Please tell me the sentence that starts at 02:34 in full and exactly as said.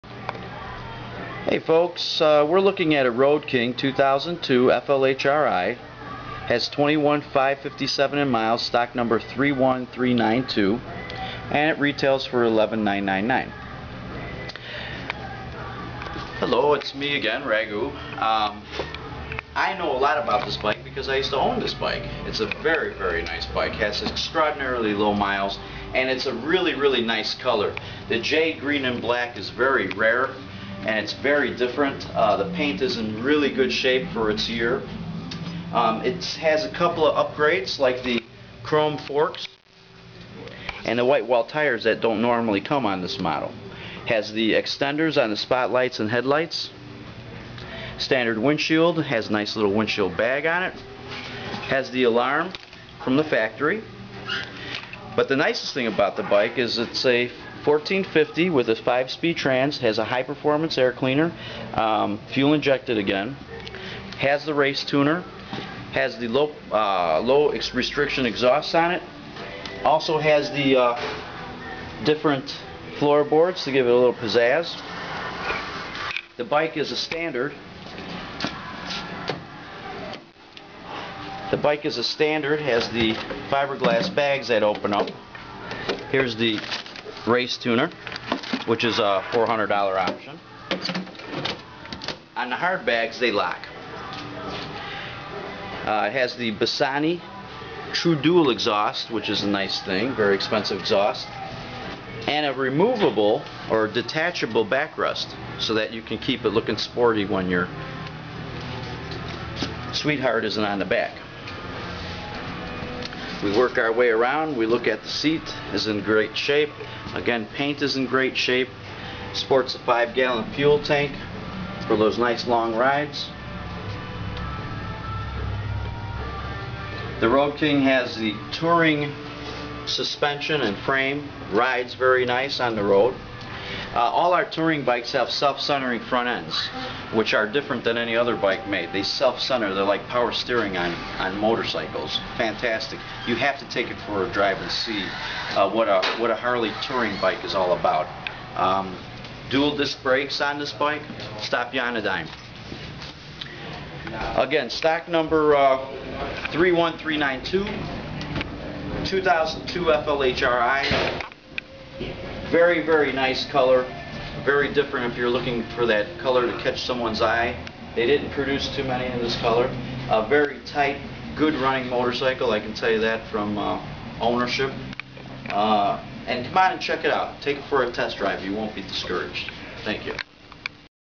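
Again, stock number uh, 31392, 2002 FLHRI.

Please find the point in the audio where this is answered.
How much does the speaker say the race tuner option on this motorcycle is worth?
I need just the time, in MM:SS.
01:29.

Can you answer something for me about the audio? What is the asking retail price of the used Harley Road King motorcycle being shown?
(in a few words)
$11,999.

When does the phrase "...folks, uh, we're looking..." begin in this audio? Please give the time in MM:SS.
00:01.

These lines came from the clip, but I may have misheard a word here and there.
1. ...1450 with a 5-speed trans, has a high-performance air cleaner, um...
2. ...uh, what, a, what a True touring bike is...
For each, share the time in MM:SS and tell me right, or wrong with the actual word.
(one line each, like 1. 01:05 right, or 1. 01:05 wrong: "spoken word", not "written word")
1. 00:57 right
2. 02:25 wrong: "Harley", not "True".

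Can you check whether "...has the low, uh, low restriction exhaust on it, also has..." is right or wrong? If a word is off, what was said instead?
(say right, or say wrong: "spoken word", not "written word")
right.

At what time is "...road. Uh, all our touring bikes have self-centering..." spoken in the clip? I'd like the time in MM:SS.
02:12.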